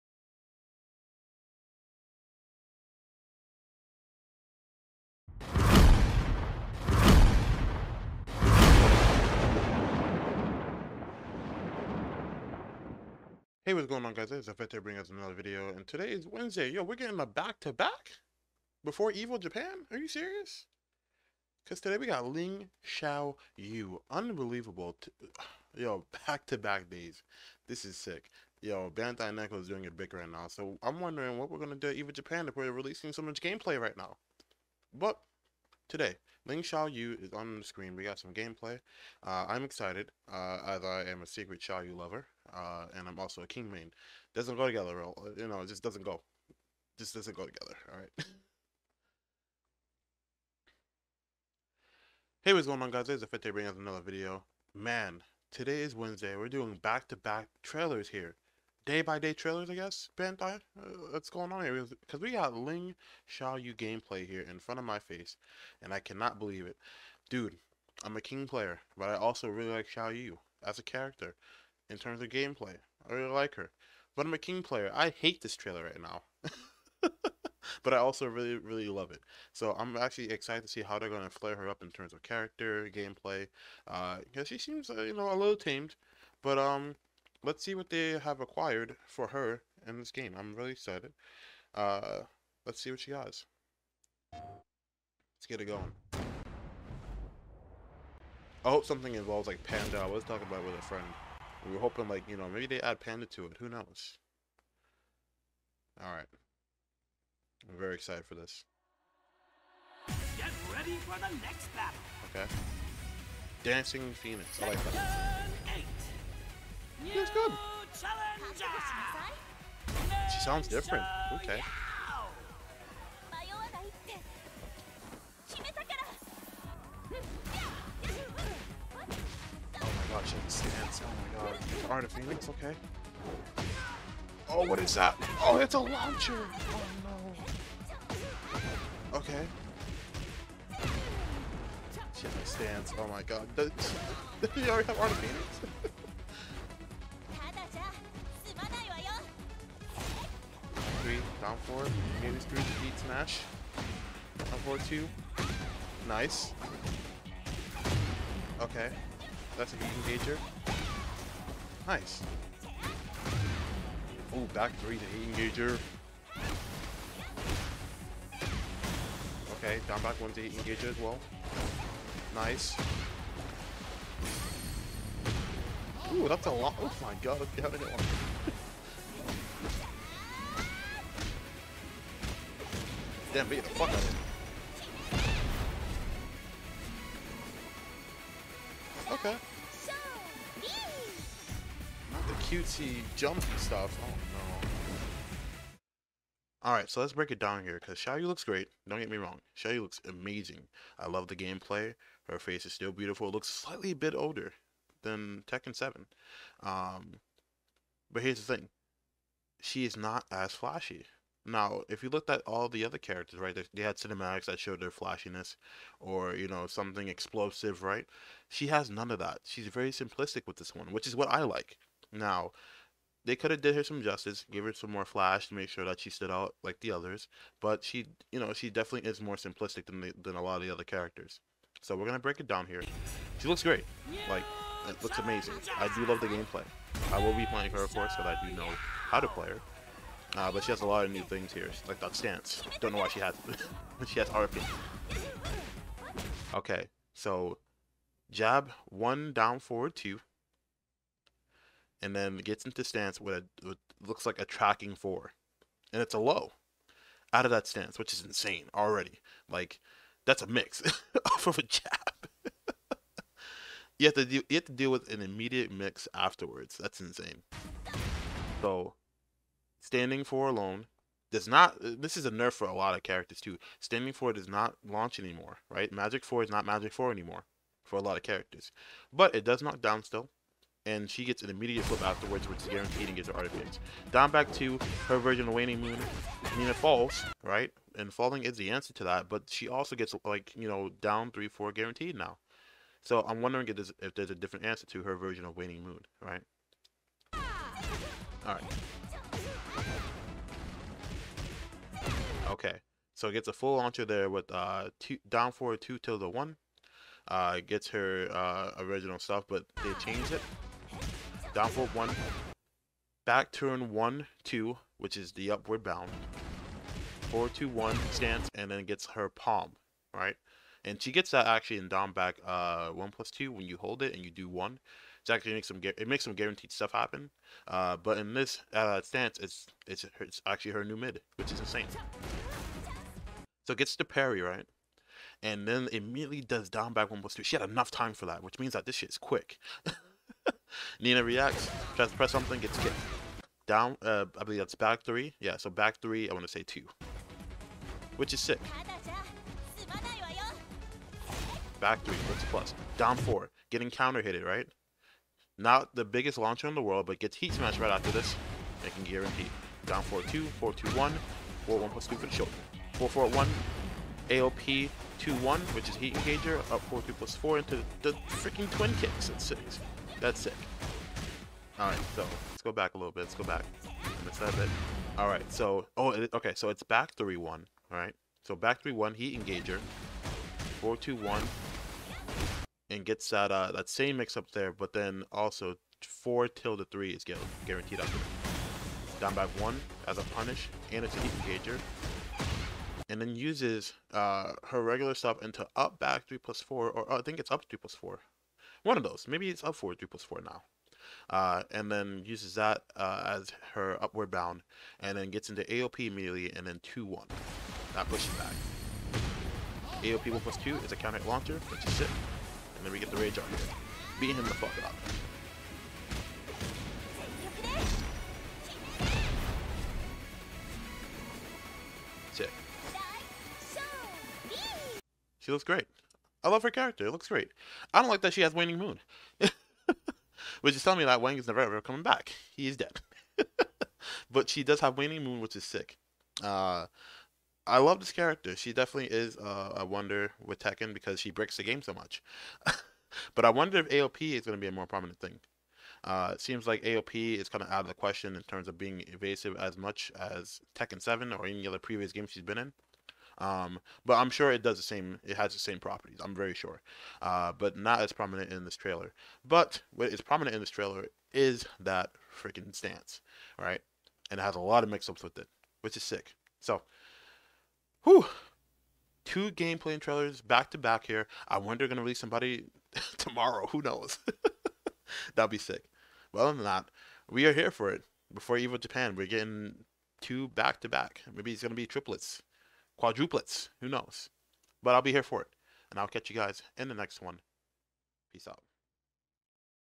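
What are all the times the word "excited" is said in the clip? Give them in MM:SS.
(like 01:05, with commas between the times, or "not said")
00:39, 01:20, 01:30, 01:47.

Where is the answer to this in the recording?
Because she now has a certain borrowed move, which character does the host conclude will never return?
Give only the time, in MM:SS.
07:11.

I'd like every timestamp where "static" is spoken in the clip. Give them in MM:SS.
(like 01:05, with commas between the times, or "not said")
not said.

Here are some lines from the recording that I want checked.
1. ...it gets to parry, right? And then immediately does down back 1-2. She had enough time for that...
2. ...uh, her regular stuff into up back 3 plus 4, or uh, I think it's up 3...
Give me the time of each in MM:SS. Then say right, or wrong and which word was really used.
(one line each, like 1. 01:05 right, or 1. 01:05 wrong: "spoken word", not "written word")
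1. 05:33 right
2. 06:34 right.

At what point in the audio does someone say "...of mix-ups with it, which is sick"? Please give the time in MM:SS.
07:44.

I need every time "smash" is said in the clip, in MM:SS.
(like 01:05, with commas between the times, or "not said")
02:33, 05:57.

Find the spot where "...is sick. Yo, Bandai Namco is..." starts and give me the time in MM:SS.
00:27.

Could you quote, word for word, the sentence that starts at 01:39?
I was talking about with a friend.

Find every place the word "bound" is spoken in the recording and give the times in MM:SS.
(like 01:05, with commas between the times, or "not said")
05:15, 06:44.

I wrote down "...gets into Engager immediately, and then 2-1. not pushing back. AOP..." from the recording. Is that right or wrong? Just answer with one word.
wrong.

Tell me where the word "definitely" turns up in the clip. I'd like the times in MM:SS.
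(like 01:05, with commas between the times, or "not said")
03:48, 07:18.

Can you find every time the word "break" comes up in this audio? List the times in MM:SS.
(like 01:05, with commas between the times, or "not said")
03:17, 03:52, 07:21.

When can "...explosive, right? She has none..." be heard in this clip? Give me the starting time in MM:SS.
03:37.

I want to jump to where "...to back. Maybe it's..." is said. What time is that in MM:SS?
08:00.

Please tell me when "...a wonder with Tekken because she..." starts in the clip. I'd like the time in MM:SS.
07:19.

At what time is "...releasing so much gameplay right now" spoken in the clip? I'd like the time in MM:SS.
00:32.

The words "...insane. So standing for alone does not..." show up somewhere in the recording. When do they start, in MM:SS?
04:27.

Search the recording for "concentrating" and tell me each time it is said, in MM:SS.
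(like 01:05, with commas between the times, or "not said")
not said.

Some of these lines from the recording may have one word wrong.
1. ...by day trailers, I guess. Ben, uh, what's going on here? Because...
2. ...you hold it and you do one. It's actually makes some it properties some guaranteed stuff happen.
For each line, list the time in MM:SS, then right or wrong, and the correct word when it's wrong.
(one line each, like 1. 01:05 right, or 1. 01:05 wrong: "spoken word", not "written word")
1. 00:59 right
2. 05:23 wrong: "makes", not "properties".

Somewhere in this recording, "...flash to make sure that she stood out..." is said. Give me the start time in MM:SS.
03:45.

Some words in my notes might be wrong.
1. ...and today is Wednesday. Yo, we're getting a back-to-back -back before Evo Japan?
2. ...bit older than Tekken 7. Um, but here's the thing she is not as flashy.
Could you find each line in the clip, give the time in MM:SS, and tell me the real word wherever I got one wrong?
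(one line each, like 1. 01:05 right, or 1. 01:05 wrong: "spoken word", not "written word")
1. 00:15 right
2. 03:23 right.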